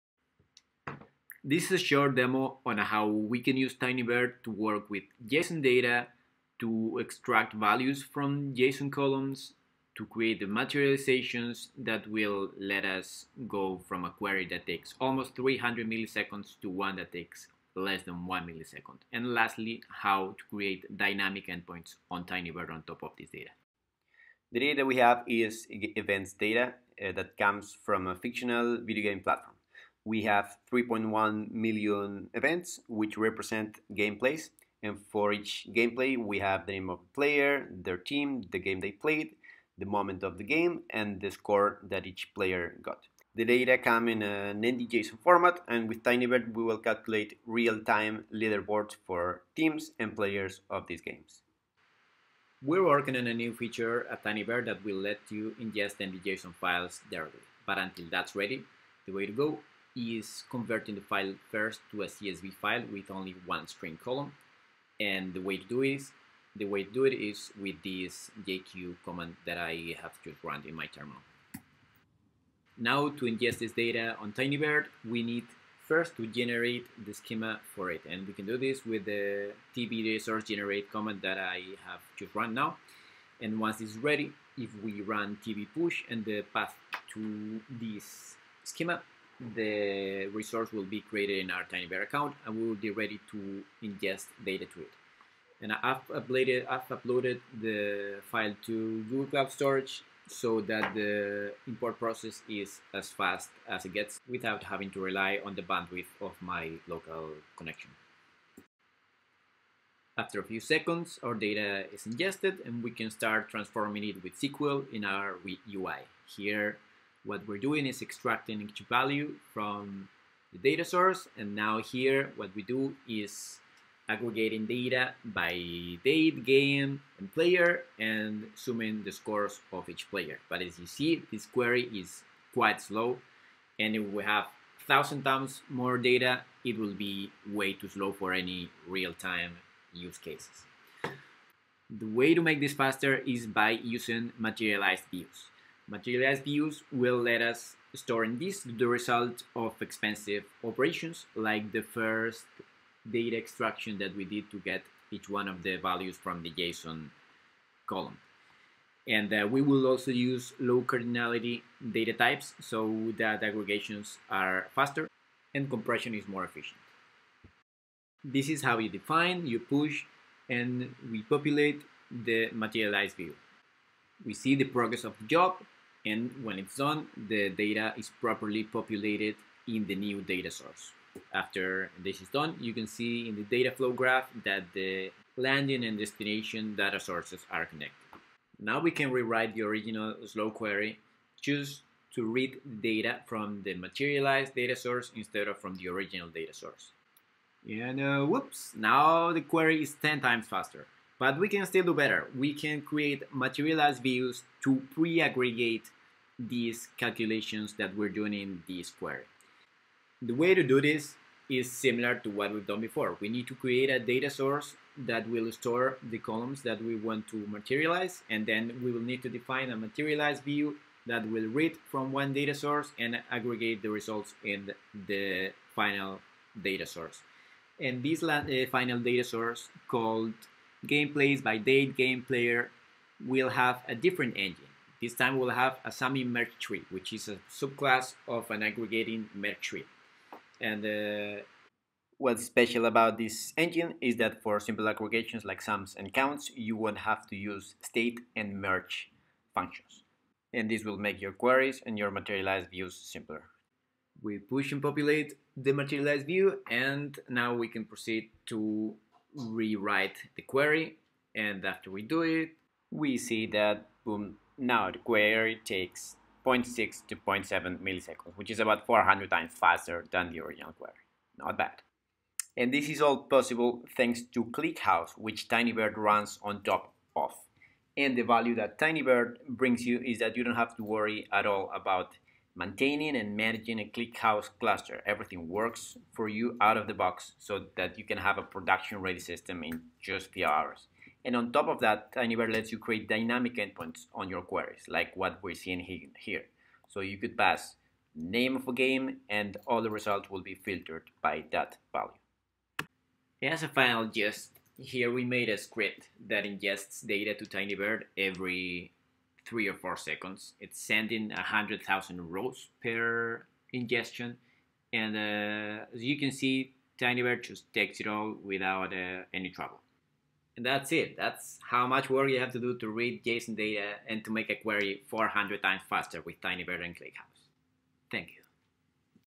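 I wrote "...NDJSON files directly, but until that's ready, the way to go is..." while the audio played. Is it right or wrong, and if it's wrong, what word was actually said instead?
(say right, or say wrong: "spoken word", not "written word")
right.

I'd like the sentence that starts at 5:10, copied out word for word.
It's sending 100,000 rows per ingestion.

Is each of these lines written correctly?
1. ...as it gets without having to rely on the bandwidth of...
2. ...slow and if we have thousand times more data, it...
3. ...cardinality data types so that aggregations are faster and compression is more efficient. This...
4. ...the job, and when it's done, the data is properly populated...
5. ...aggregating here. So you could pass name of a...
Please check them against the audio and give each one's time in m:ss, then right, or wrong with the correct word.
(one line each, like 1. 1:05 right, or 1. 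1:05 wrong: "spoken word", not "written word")
1. 1:43 right
2. 2:12 right
3. 2:40 right
4. 2:55 right
5. 4:55 wrong: "seeing", not "aggregating".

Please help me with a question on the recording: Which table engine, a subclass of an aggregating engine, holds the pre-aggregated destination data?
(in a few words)
summing merge tree.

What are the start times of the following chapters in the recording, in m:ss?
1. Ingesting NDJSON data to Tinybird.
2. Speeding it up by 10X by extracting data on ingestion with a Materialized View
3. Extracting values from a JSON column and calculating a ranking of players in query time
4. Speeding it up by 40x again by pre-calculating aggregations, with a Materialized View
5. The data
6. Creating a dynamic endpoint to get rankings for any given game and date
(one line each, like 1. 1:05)
1. 0:51
2. 2:20
3. 1:49
4. 3:20
5. 0:23
6. 4:30.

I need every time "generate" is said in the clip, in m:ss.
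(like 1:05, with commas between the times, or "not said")
1:16, 1:20.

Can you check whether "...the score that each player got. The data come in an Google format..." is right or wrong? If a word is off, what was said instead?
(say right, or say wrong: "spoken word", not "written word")
wrong: "NDJSON", not "Google".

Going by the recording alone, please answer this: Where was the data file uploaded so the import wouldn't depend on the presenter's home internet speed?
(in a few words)
Google Cloud Storage.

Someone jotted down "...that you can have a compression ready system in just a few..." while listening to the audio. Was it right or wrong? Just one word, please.
wrong.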